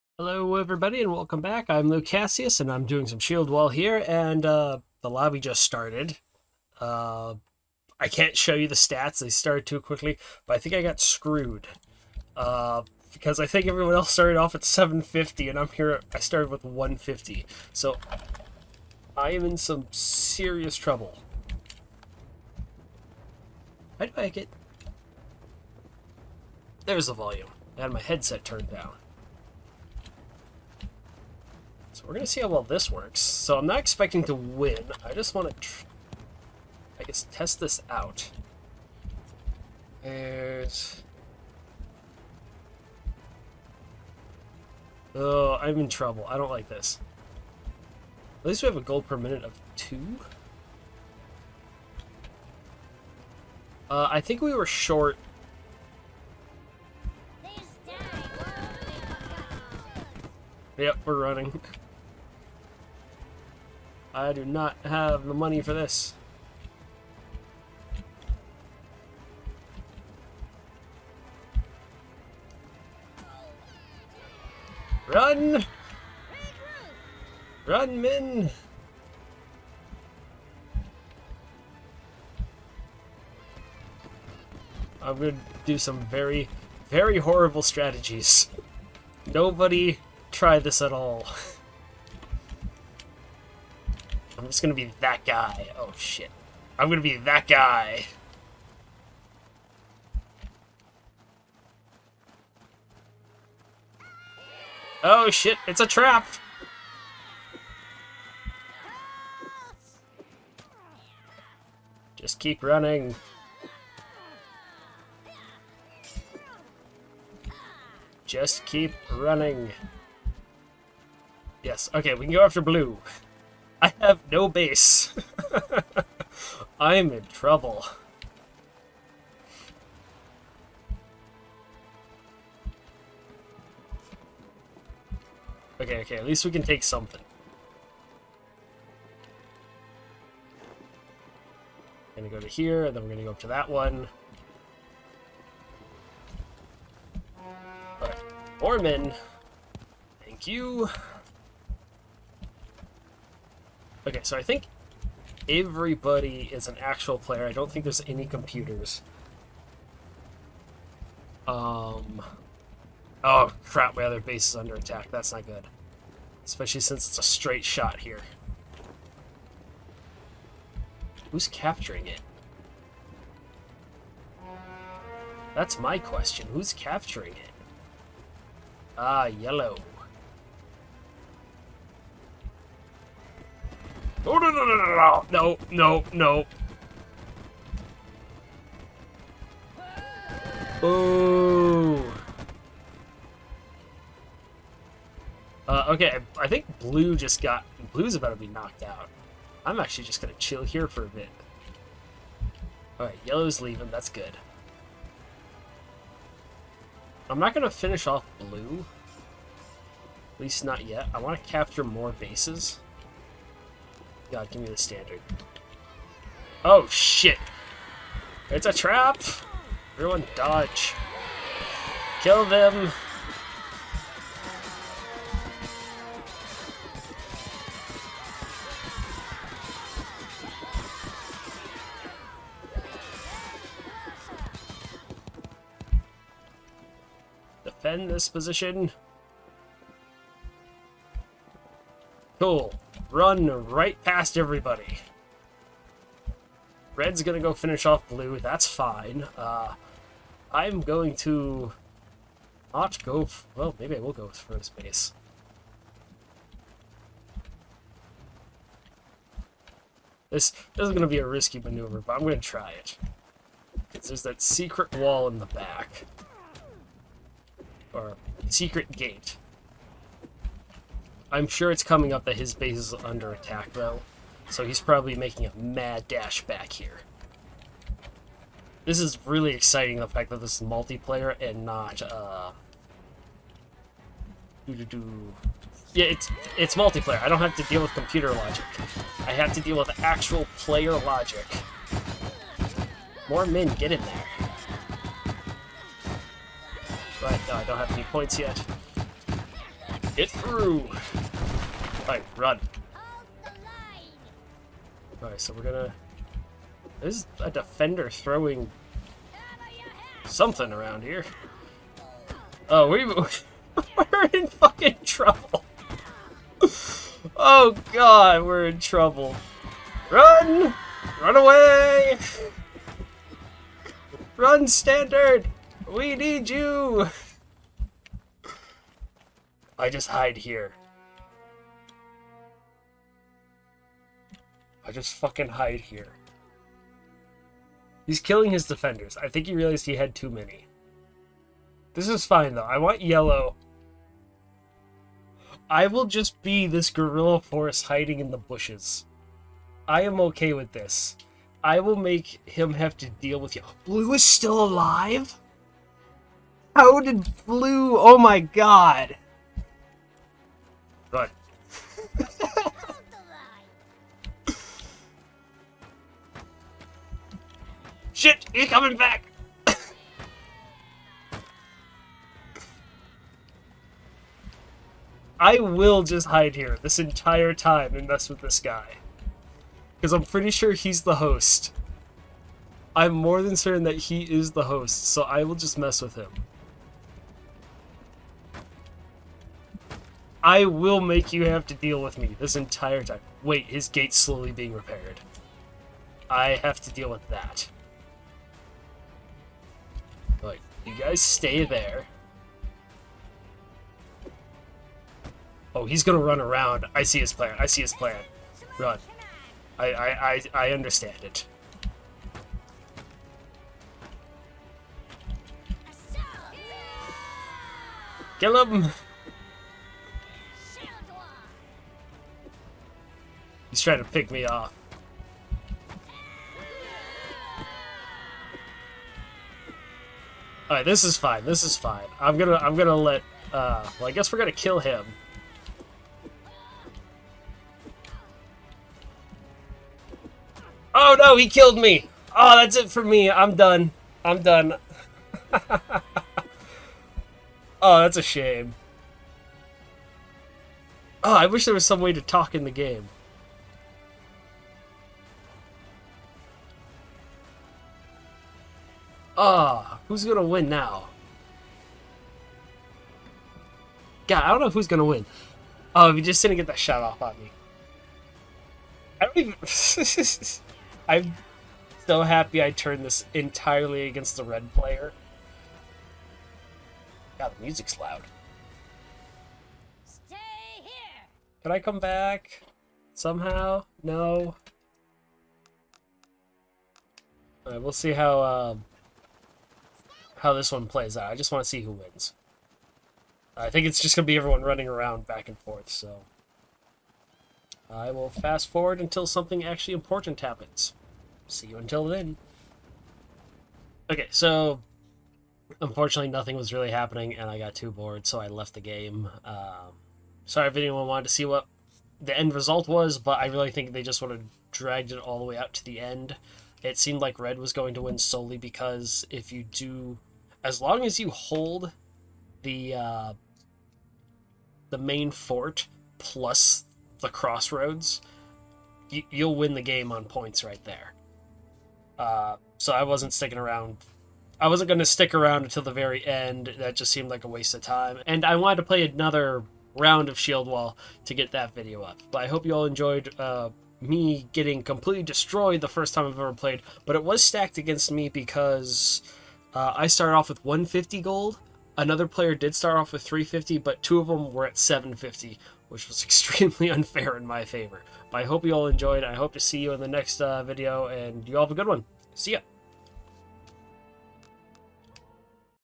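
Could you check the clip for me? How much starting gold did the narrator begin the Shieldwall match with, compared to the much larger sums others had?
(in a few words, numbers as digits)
150.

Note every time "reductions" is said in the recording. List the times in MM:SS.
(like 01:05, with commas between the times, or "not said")
not said.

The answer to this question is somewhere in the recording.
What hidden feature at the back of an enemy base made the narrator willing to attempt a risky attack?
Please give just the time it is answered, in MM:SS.
04:27.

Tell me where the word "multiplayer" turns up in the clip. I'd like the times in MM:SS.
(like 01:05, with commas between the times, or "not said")
04:40, 04:46.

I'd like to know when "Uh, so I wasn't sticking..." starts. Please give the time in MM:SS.
08:52.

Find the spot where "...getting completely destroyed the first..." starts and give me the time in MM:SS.
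09:04.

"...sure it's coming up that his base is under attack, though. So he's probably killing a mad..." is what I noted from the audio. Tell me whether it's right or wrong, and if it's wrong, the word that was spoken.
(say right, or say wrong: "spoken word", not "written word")
wrong: "making", not "killing".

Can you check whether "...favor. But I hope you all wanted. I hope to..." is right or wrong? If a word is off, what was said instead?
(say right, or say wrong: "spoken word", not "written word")
wrong: "enjoyed", not "wanted".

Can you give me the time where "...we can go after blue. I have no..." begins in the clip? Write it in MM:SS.
02:02.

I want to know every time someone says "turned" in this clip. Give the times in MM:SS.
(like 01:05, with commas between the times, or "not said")
00:28, 07:52.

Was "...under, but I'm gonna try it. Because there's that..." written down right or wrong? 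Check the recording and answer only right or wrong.
wrong.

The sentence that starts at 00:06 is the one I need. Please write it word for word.
Uh, I can't show you the stats.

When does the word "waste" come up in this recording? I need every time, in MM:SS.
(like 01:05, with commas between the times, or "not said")
08:57.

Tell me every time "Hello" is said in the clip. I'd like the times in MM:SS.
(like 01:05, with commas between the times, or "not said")
00:00.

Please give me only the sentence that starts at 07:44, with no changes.
God, I don't know who's gonna win.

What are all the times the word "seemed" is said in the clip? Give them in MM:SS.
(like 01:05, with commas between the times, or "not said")
08:36, 08:57.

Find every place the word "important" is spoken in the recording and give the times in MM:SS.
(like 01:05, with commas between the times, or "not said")
08:19.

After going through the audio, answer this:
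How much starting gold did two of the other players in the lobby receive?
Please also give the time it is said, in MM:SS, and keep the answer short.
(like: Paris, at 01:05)
750, at 09:14.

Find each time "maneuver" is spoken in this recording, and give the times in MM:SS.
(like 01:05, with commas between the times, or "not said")
04:21.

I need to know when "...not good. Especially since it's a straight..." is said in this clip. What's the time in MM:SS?
02:45.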